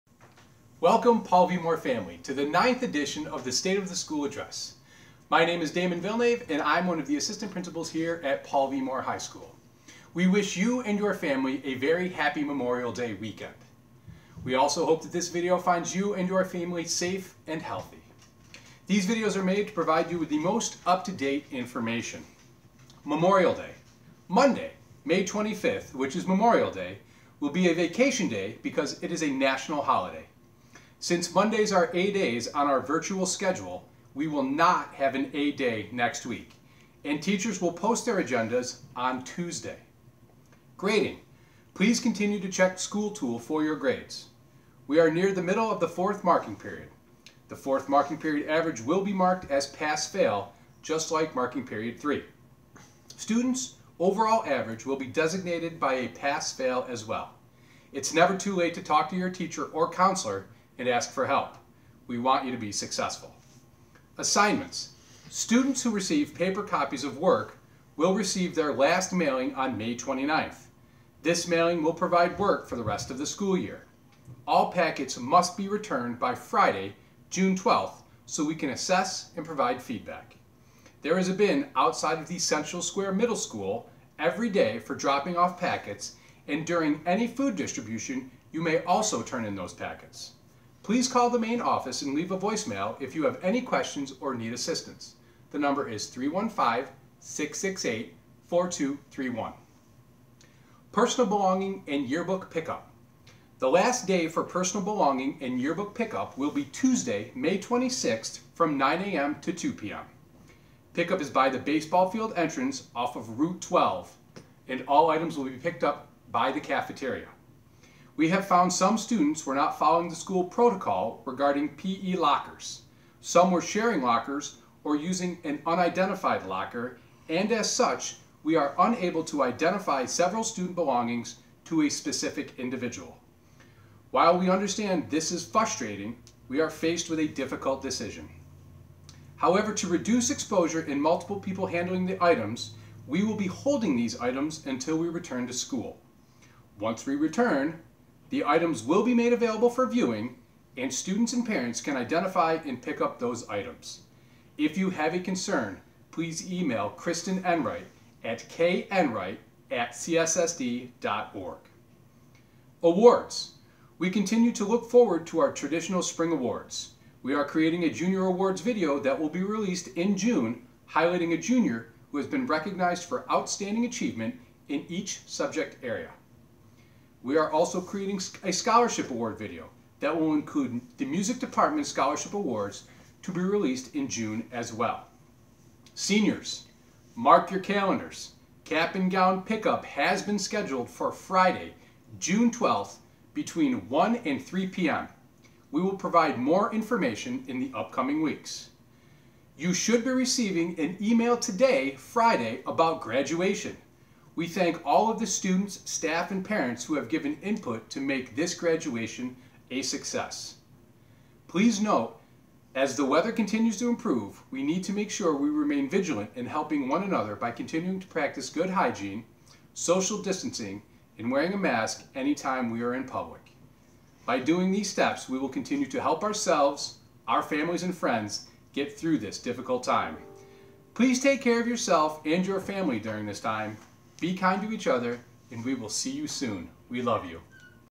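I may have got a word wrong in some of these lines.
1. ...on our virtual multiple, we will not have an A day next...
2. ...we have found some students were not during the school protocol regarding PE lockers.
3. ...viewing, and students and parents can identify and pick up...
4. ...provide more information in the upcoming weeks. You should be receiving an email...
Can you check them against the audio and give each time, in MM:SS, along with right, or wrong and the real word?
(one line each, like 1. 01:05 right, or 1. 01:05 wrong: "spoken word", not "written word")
1. 00:32 wrong: "schedule", not "multiple"
2. 01:58 wrong: "following", not "during"
3. 02:29 right
4. 03:15 right.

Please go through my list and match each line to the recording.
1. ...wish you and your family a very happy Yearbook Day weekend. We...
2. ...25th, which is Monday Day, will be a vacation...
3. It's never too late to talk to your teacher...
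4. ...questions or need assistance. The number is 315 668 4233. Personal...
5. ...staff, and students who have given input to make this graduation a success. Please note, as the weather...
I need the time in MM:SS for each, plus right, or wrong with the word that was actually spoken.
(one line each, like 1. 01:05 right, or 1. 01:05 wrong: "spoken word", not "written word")
1. 00:10 wrong: "Memorial", not "Yearbook"
2. 00:25 wrong: "Memorial", not "Monday"
3. 00:57 right
4. 01:33 wrong: "4231", not "4233"
5. 03:25 wrong: "parents", not "students".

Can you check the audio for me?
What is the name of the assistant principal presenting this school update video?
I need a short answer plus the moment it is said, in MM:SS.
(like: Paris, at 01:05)
Damon Villnave, at 00:05.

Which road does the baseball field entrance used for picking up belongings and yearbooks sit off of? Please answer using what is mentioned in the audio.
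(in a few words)
Route 12.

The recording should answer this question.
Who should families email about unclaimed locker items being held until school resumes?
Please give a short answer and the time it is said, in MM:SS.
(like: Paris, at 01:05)
Kristen Enright, at 02:36.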